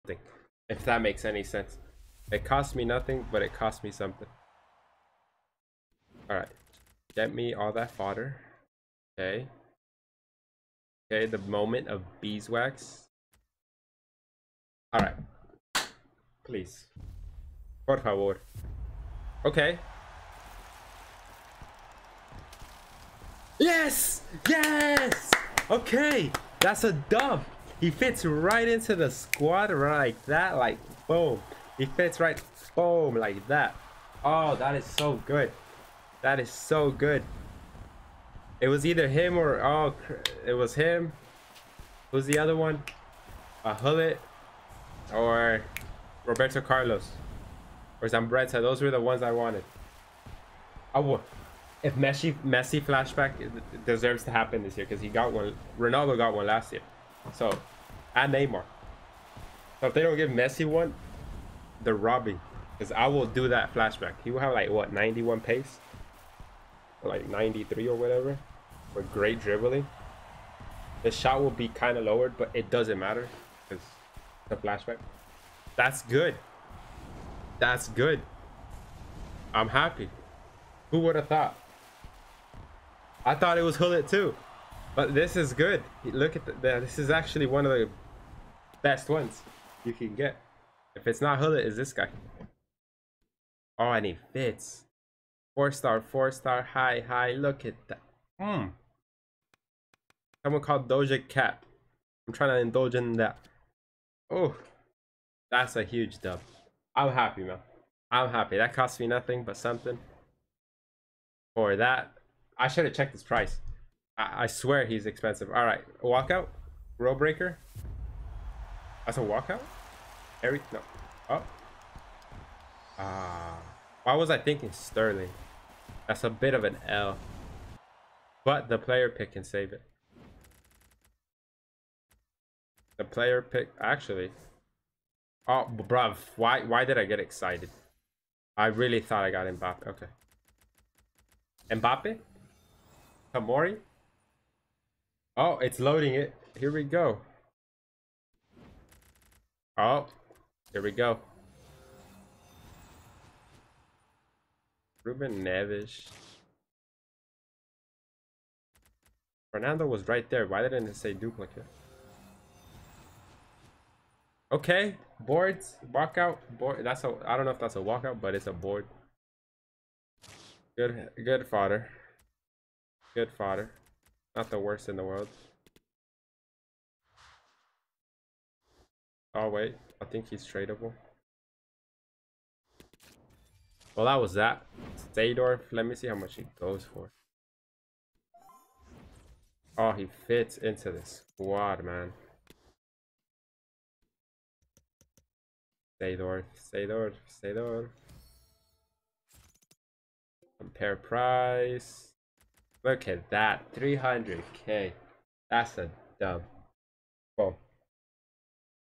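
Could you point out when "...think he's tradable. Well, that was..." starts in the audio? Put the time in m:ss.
3:00.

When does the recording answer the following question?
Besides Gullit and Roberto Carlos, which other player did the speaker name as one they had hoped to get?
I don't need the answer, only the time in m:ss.
0:48.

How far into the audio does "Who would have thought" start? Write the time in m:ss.
1:20.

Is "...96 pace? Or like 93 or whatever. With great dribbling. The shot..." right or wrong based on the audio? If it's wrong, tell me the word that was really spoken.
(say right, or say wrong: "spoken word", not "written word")
wrong: "91", not "96".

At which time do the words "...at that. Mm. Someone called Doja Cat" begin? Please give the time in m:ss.
1:37.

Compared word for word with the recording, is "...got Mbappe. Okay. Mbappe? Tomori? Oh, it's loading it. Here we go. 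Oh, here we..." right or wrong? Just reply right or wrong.
right.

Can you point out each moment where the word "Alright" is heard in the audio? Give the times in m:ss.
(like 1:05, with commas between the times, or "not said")
0:06, 0:14.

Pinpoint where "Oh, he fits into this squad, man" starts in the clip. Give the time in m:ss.
3:09.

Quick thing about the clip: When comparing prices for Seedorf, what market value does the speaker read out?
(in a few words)
300k.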